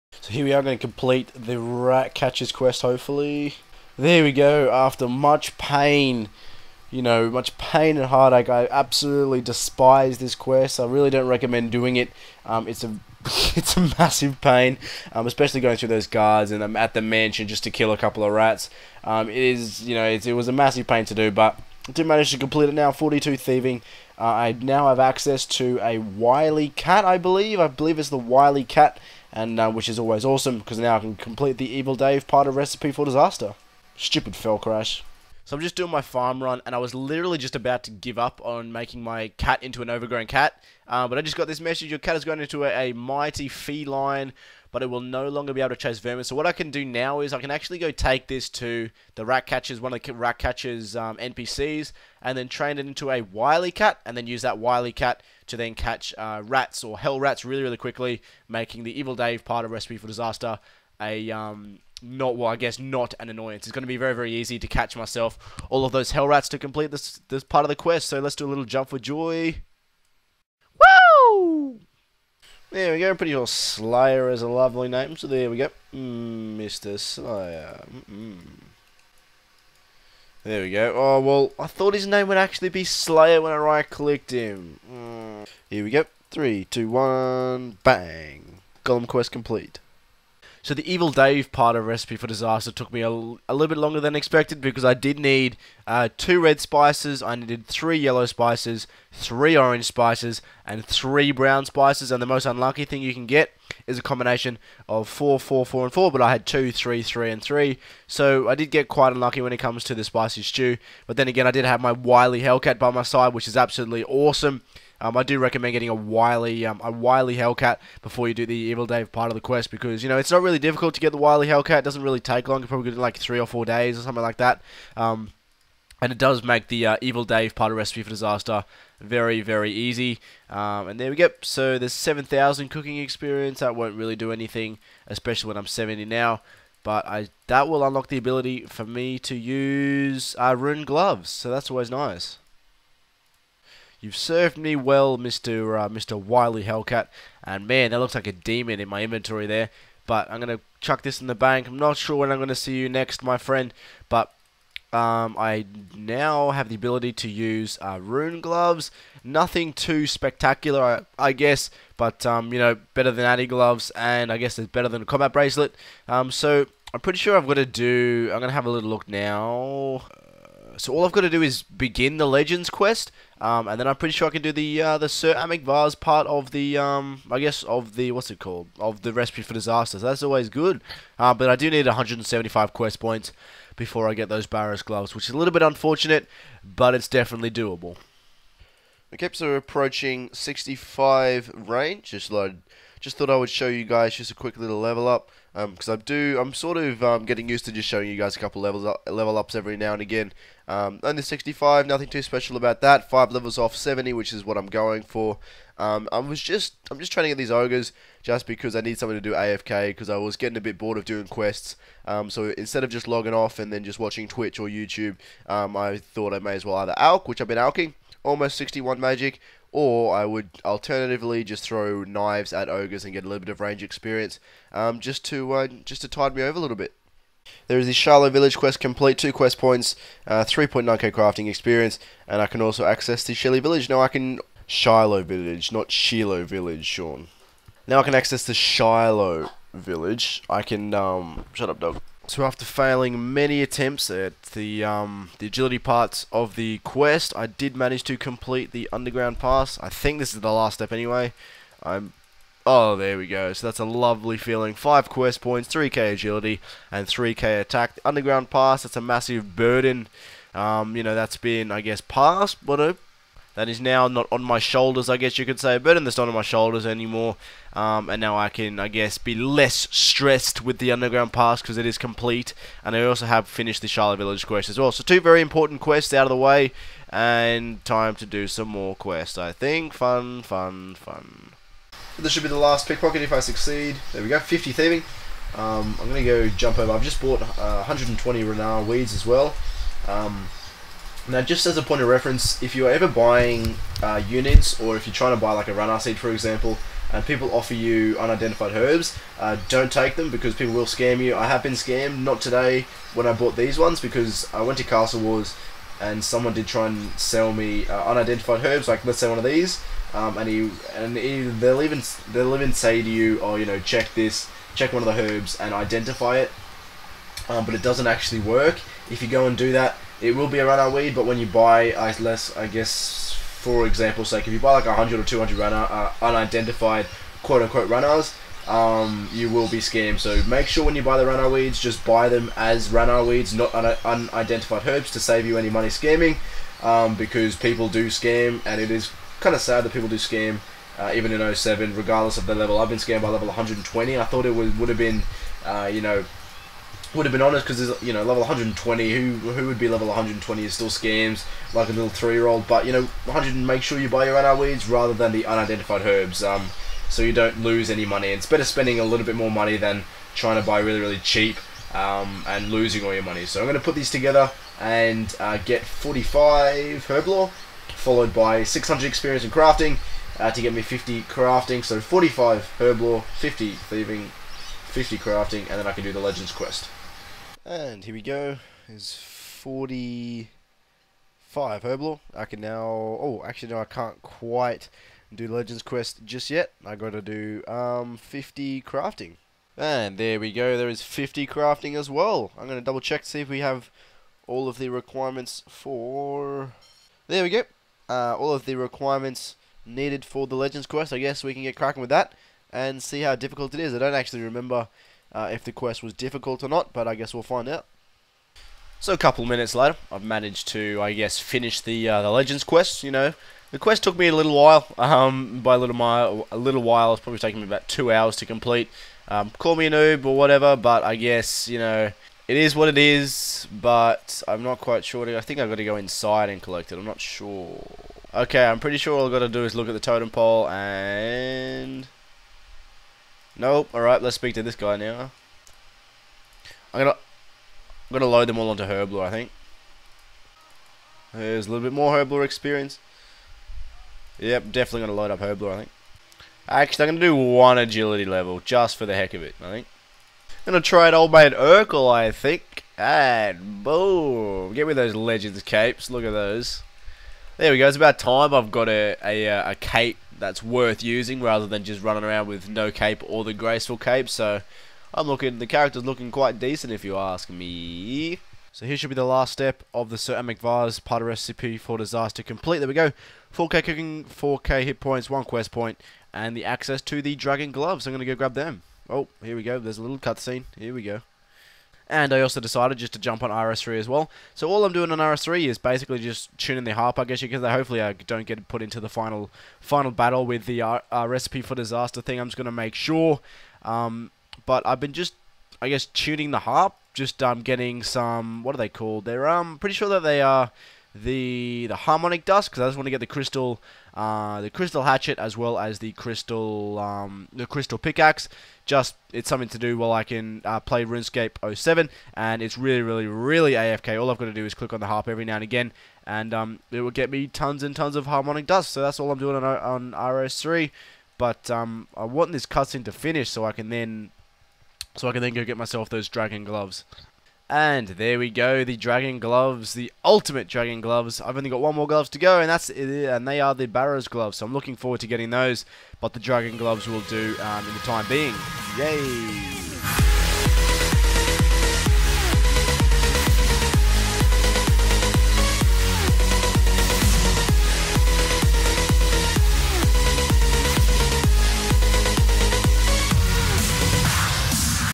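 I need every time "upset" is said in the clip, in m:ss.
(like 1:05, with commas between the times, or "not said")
not said.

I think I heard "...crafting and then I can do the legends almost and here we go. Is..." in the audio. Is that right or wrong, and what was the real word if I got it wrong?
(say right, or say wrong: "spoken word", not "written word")
wrong: "quest", not "almost".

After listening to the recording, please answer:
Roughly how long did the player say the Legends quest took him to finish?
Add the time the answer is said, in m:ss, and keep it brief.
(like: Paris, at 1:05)
about two hours, at 6:57.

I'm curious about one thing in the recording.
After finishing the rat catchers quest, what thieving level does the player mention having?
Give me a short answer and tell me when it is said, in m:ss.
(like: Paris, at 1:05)
42, at 0:22.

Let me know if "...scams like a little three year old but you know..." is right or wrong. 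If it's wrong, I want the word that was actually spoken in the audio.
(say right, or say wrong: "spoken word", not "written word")
right.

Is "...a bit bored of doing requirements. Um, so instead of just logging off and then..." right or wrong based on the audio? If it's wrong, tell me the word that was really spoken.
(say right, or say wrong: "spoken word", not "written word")
wrong: "quests", not "requirements".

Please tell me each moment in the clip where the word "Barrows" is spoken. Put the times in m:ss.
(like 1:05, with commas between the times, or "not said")
3:04, 8:53.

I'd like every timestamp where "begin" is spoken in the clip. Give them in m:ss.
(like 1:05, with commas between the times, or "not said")
2:51.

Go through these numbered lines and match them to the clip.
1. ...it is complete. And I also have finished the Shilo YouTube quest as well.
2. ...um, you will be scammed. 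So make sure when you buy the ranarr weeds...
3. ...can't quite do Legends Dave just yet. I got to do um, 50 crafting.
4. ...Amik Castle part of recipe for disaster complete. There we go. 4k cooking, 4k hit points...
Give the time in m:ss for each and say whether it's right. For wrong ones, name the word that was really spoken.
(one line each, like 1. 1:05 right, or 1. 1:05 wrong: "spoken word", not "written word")
1. 4:31 wrong: "Village", not "YouTube"
2. 5:28 right
3. 6:23 wrong: "Quest", not "Dave"
4. 7:50 wrong: "Varze", not "Castle".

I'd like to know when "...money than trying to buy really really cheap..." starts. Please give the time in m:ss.
5:59.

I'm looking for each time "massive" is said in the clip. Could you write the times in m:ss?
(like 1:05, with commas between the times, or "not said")
0:13, 0:20, 4:19.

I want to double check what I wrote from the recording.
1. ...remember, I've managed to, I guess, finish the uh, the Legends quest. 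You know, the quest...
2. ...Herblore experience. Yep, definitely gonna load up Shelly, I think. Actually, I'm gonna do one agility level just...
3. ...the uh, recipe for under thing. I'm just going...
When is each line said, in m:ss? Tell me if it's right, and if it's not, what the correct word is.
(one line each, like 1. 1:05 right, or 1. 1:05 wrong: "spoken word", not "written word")
1. 6:49 wrong: "later", not "remember"
2. 7:22 wrong: "Herblore", not "Shelly"
3. 8:10 wrong: "disaster", not "under".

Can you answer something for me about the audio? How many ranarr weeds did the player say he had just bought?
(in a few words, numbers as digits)
120.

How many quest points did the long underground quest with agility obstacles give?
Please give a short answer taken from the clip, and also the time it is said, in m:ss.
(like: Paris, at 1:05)
5, at 4:14.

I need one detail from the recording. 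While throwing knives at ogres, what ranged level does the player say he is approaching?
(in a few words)
65.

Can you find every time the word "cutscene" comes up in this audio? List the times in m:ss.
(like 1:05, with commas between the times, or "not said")
8:00, 8:42.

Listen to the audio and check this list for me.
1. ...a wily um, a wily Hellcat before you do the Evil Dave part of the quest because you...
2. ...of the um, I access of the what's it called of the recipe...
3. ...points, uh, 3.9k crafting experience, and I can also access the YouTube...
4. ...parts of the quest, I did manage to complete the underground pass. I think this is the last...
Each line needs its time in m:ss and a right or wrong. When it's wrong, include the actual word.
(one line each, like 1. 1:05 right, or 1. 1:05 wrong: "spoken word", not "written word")
1. 1:55 right
2. 2:56 wrong: "guess", not "access"
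3. 3:49 wrong: "Shelly", not "YouTube"
4. 4:05 right.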